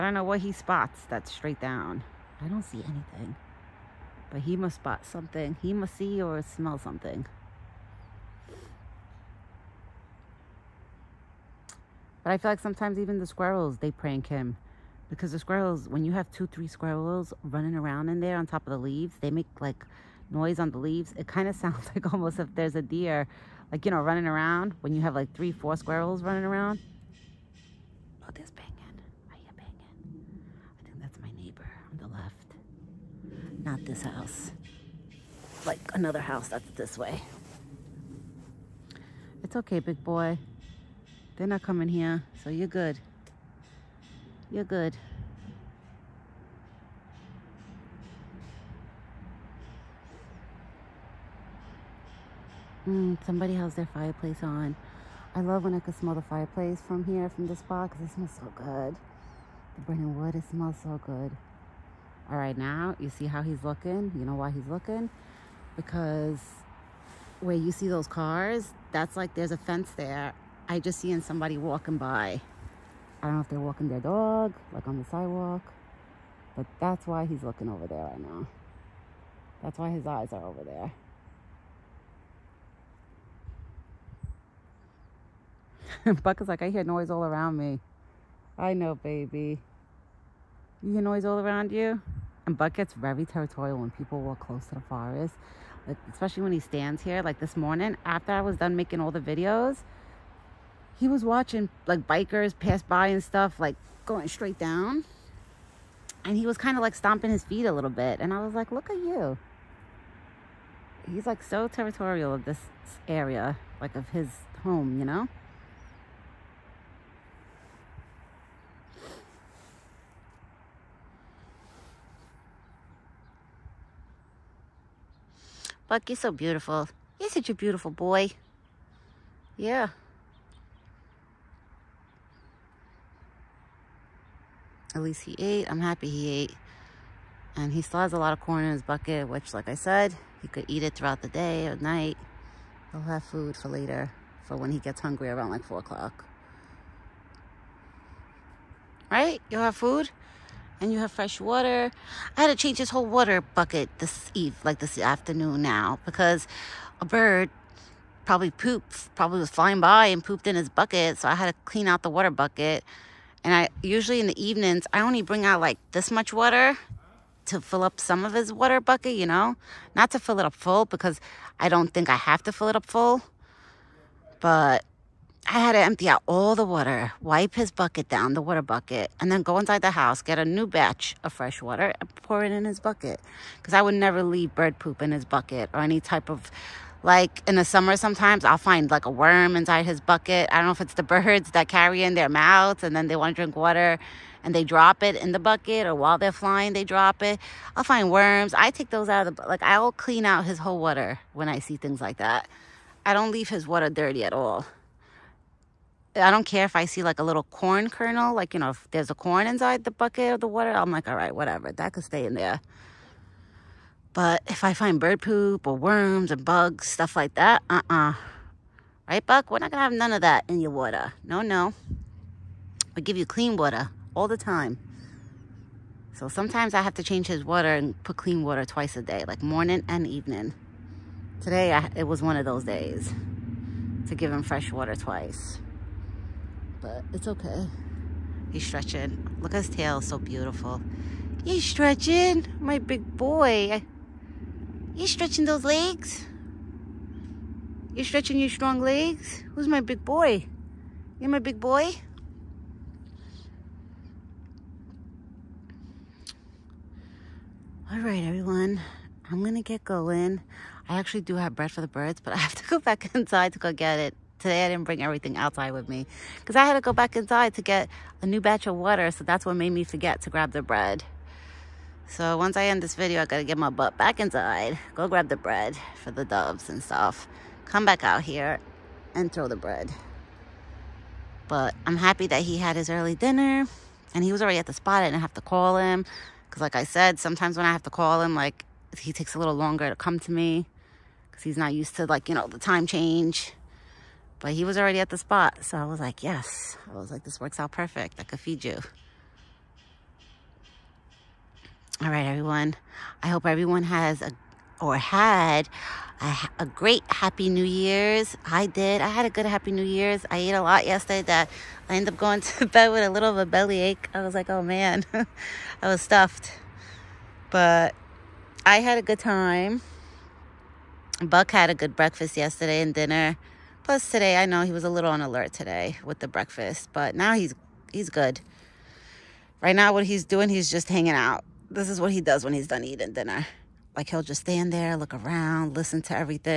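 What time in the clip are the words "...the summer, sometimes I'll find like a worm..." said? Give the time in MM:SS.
03:07.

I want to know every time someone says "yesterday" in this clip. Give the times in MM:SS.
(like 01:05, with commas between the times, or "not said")
05:10, 05:22.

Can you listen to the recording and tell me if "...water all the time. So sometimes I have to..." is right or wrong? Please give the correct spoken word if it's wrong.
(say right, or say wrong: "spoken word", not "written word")
right.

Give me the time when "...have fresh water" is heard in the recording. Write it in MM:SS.
02:30.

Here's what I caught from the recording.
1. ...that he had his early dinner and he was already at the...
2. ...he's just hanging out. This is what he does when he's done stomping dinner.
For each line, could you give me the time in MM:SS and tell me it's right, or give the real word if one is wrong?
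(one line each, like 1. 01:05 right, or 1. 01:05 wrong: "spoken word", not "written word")
1. 04:42 right
2. 05:30 wrong: "eating", not "stomping".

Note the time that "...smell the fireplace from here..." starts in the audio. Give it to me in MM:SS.
00:55.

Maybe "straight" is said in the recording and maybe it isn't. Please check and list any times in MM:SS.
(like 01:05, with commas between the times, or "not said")
00:01, 01:44.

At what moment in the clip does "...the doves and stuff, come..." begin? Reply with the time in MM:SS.
04:36.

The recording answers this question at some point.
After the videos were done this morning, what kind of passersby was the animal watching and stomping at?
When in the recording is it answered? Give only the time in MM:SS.
01:42.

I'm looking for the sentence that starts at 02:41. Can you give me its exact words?
So I had to clean out the water bucket.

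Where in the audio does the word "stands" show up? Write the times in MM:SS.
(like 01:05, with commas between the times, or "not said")
01:36, 05:34.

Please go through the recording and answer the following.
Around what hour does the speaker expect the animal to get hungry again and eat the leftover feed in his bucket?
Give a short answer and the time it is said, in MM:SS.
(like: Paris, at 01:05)
4 o'clock, at 02:25.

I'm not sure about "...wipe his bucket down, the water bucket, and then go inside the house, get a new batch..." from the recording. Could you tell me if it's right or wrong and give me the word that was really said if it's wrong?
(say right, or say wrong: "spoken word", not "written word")
right.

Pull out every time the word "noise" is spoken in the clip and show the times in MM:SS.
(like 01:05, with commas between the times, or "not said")
00:20, 01:26, 01:31.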